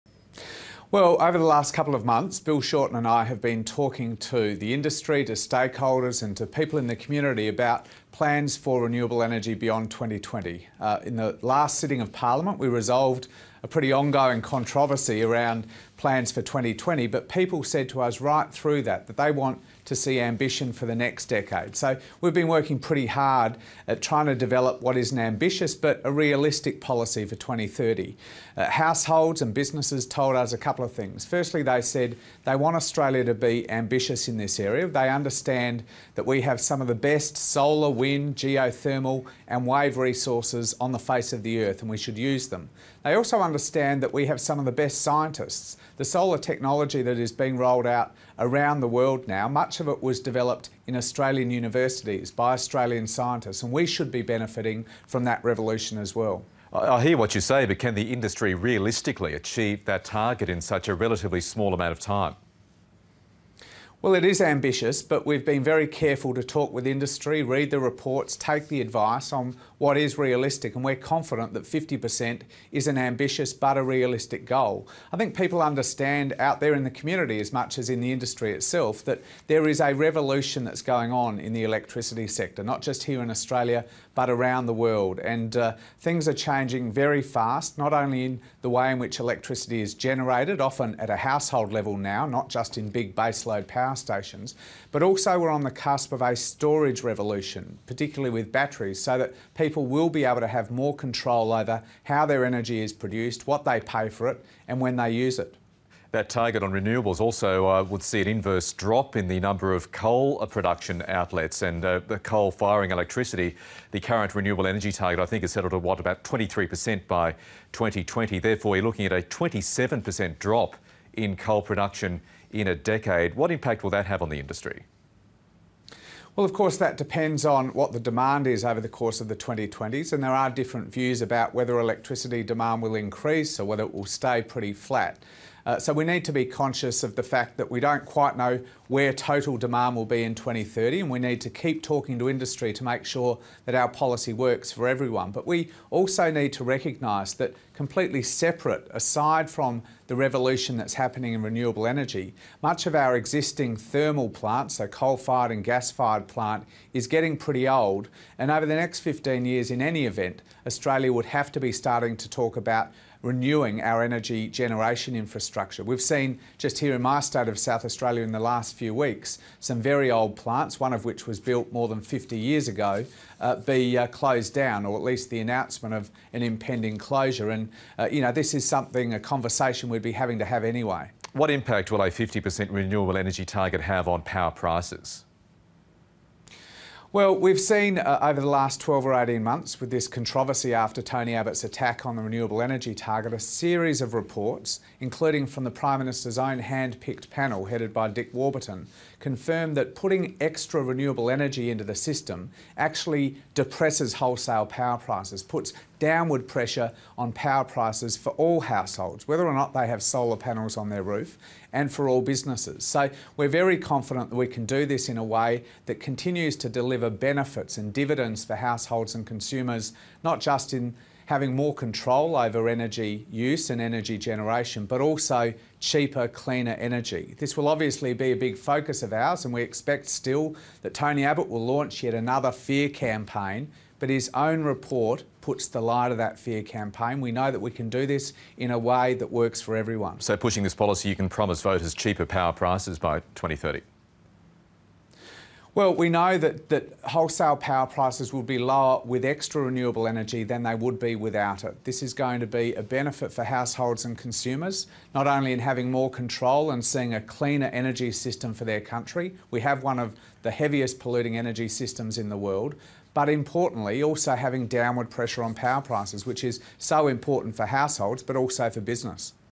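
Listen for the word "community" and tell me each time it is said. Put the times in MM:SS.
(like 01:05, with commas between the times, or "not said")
00:06, 01:16.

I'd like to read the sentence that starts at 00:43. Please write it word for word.
They also understand that we have some of the best scientists.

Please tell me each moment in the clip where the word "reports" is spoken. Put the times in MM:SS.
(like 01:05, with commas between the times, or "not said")
01:07, 03:14, 03:54.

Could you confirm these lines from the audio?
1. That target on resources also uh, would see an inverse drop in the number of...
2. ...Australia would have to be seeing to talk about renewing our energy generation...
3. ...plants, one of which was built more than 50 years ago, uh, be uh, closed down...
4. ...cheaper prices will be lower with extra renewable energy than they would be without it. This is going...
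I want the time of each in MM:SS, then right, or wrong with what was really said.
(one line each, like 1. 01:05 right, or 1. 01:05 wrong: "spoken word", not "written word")
1. 01:46 wrong: "renewables", not "resources"
2. 02:40 wrong: "starting", not "seeing"
3. 02:50 right
4. 04:07 wrong: "power", not "cheaper".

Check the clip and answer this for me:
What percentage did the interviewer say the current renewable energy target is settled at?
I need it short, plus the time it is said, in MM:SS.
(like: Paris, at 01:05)
23%, at 01:56.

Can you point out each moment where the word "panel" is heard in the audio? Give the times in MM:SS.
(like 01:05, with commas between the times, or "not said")
03:17, 03:30.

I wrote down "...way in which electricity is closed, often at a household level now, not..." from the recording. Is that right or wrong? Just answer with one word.
wrong.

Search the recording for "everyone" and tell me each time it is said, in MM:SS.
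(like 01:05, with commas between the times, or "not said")
02:24, 03:59.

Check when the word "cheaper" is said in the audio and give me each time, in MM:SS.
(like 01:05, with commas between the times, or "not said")
03:45, 04:01.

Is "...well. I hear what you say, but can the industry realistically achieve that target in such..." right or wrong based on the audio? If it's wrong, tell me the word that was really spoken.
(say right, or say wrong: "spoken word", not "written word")
right.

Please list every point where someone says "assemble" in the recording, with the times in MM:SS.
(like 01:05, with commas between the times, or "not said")
not said.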